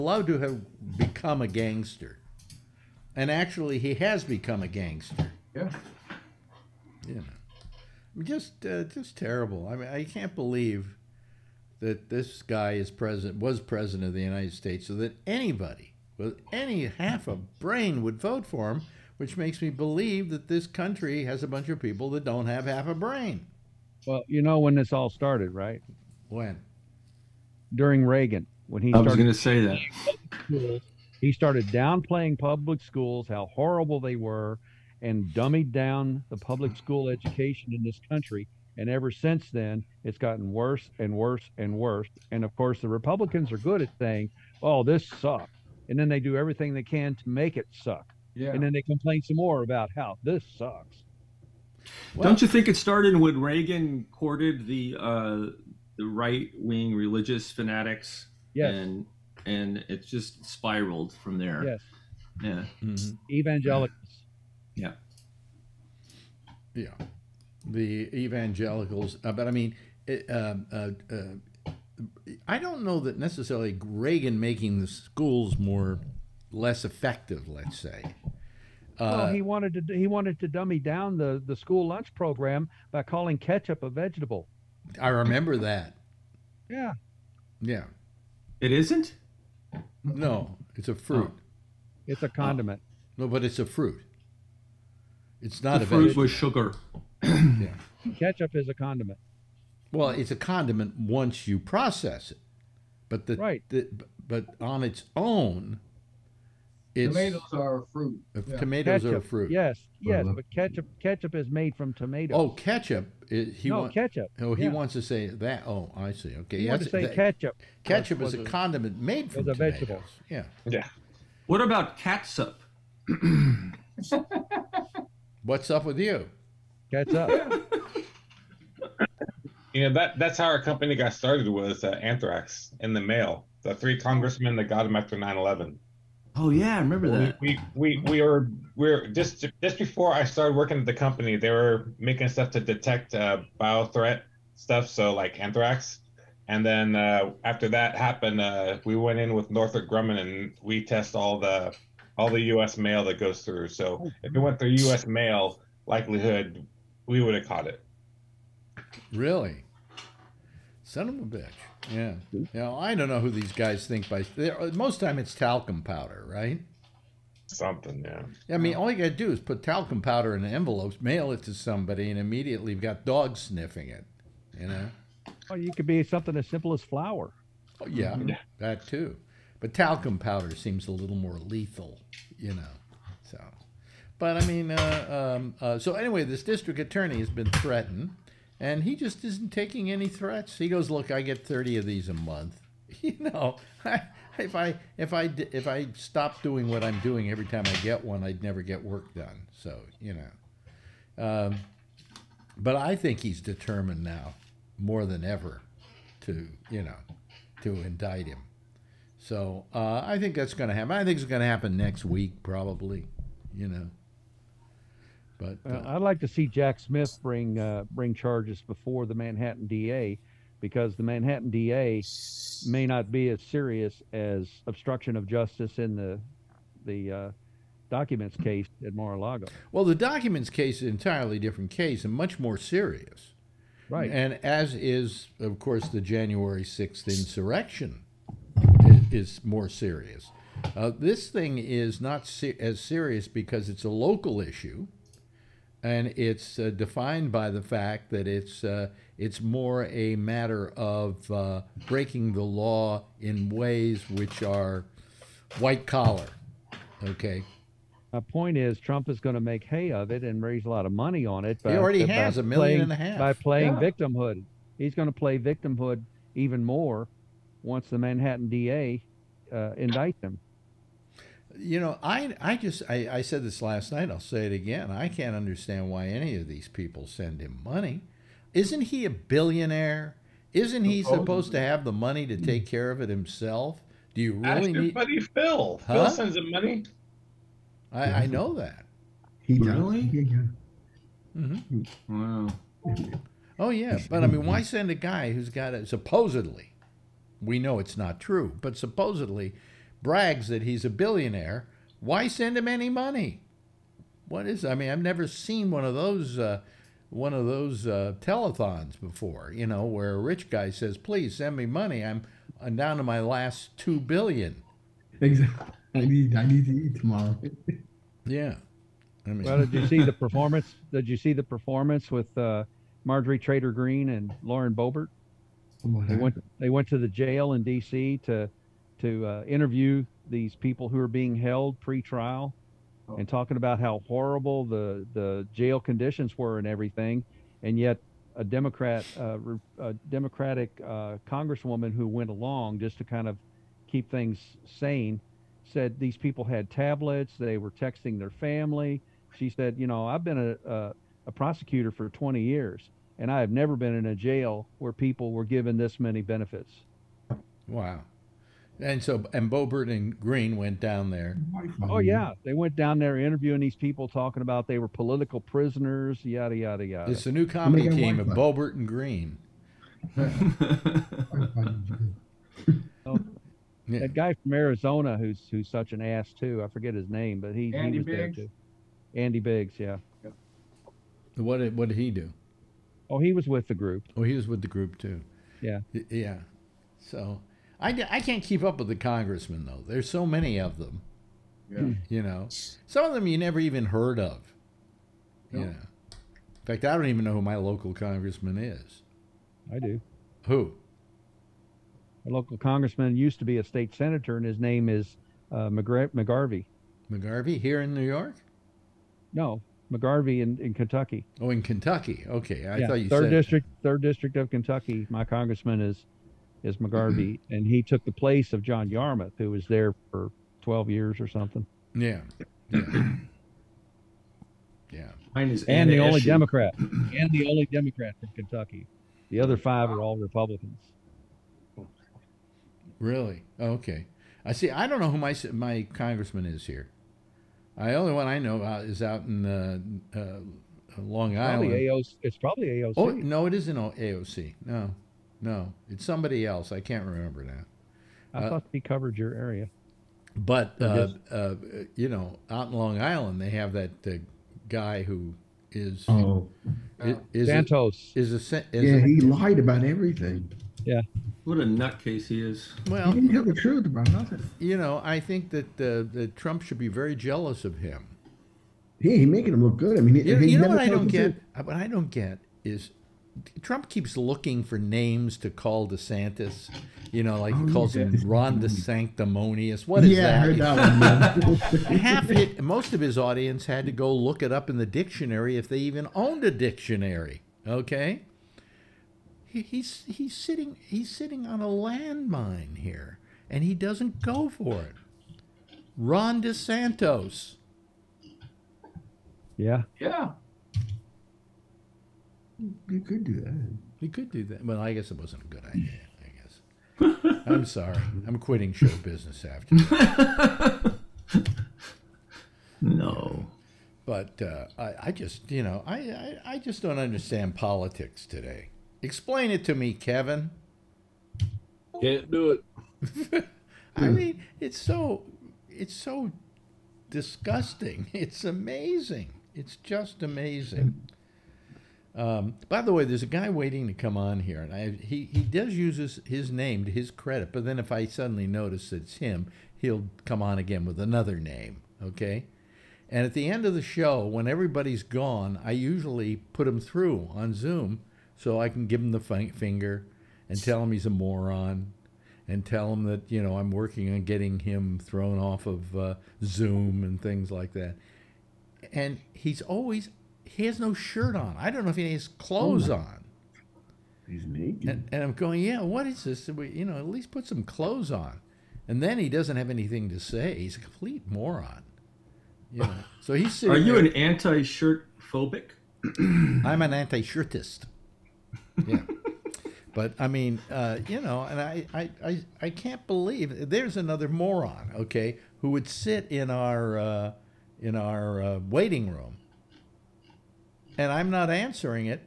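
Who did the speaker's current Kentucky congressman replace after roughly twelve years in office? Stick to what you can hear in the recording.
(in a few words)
John Yarmouth.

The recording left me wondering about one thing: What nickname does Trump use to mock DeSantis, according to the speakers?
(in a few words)
Ron the Sanctimonious.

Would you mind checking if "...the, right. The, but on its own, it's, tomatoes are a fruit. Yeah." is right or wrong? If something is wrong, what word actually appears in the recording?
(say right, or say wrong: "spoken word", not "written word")
right.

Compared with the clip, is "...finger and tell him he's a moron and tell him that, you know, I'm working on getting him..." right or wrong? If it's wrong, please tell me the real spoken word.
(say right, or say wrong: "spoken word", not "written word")
right.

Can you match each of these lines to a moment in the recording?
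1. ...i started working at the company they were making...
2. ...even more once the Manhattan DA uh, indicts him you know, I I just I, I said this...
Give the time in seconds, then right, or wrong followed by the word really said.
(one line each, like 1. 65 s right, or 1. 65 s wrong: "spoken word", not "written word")
1. 140 s right
2. 266 s right.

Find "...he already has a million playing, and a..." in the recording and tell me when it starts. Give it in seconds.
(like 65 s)
261 s.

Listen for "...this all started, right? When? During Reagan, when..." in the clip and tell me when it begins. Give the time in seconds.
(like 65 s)
24 s.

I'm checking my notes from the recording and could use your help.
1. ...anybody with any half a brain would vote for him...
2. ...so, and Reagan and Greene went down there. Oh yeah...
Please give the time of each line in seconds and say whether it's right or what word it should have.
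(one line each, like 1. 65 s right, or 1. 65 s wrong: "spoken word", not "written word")
1. 15 s right
2. 359 s wrong: "Boebert", not "Reagan".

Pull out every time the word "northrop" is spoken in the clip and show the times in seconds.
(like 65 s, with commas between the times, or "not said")
149 s.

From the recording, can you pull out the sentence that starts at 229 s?
Well, the documents case is an entirely different case and much more serious.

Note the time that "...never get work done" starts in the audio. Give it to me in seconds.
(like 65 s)
198 s.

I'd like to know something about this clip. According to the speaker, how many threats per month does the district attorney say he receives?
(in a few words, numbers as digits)
30.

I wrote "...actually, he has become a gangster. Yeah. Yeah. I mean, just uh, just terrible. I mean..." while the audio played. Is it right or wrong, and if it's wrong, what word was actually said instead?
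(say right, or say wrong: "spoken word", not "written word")
right.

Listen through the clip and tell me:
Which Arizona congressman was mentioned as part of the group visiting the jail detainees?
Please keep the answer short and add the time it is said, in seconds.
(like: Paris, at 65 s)
Andy Biggs, at 379 s.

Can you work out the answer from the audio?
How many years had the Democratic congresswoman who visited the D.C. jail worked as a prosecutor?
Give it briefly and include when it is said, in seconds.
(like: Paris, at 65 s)
20, at 352 s.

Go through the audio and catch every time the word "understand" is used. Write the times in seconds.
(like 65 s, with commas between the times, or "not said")
275 s, 516 s.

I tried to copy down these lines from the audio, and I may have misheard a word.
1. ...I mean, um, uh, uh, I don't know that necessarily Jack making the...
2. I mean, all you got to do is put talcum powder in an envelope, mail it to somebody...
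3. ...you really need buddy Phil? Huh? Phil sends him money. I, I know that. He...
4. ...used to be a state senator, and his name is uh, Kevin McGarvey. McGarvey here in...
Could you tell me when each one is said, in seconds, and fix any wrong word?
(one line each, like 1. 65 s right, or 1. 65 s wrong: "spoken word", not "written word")
1. 69 s wrong: "Reagan", not "Jack"
2. 168 s right
3. 284 s right
4. 403 s wrong: "McGar", not "Kevin".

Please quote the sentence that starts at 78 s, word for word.
Uh, well, he wanted to he wanted to dummy down the, the school lunch program by calling ketchup a vegetable.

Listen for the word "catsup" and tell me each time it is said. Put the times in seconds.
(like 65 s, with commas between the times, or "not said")
121 s.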